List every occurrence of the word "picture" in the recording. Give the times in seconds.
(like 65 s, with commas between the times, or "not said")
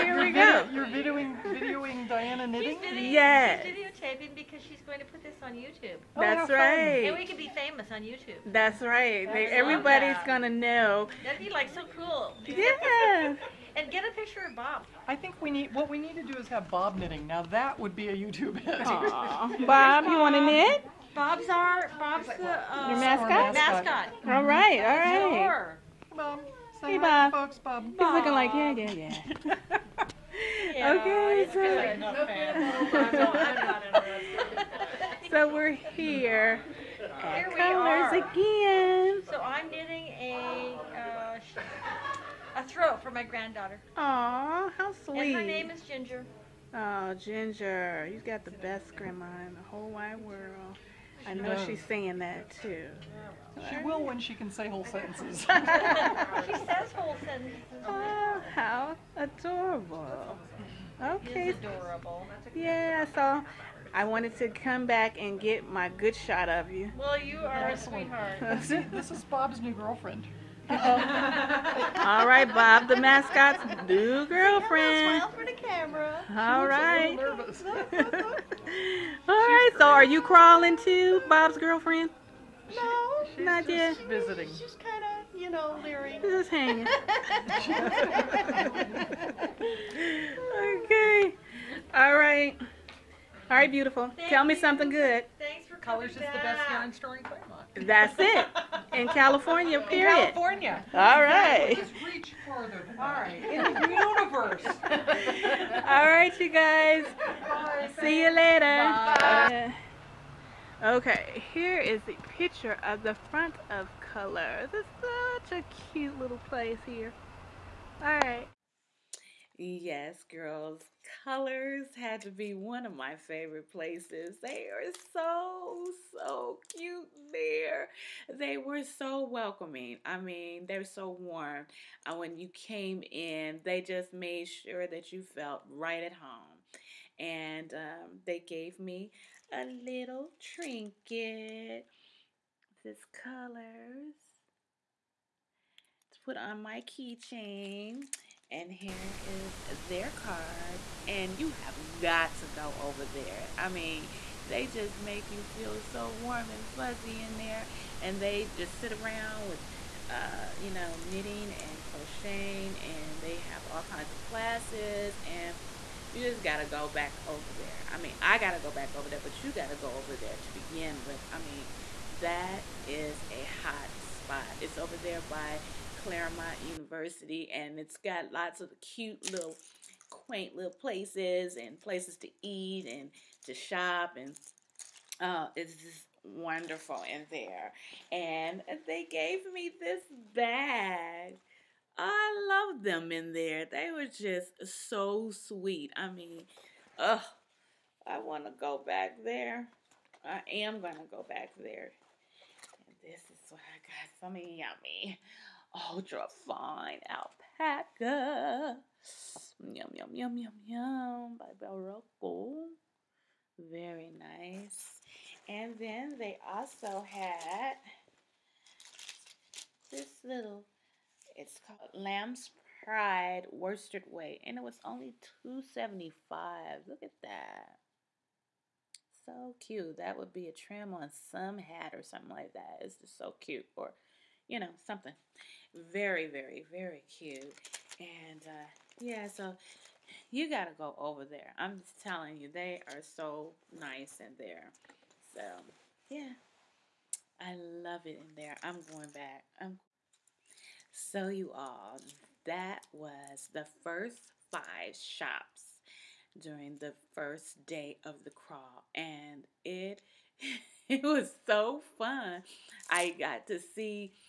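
14 s, 112 s.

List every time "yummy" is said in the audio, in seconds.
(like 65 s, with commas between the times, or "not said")
204 s.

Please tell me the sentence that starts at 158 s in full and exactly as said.
And they just sit around with, uh, you know, knitting and crocheting.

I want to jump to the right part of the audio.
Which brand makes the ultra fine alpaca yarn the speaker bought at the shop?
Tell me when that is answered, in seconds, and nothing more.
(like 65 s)
211 s.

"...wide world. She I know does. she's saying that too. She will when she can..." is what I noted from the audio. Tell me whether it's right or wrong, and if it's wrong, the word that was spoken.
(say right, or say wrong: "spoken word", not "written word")
right.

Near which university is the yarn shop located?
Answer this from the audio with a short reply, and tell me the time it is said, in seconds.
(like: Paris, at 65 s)
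Claremont University, at 176 s.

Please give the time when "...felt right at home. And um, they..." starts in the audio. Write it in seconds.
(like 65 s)
135 s.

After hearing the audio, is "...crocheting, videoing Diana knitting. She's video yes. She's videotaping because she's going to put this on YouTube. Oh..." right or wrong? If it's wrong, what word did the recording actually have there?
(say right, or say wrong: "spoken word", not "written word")
wrong: "videoing", not "crocheting".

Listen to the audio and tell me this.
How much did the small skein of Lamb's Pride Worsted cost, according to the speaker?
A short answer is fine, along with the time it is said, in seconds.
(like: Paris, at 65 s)
$2.75, at 225 s.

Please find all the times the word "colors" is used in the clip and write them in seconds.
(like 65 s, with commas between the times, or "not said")
37 s, 96 s, 114 s, 121 s, 143 s.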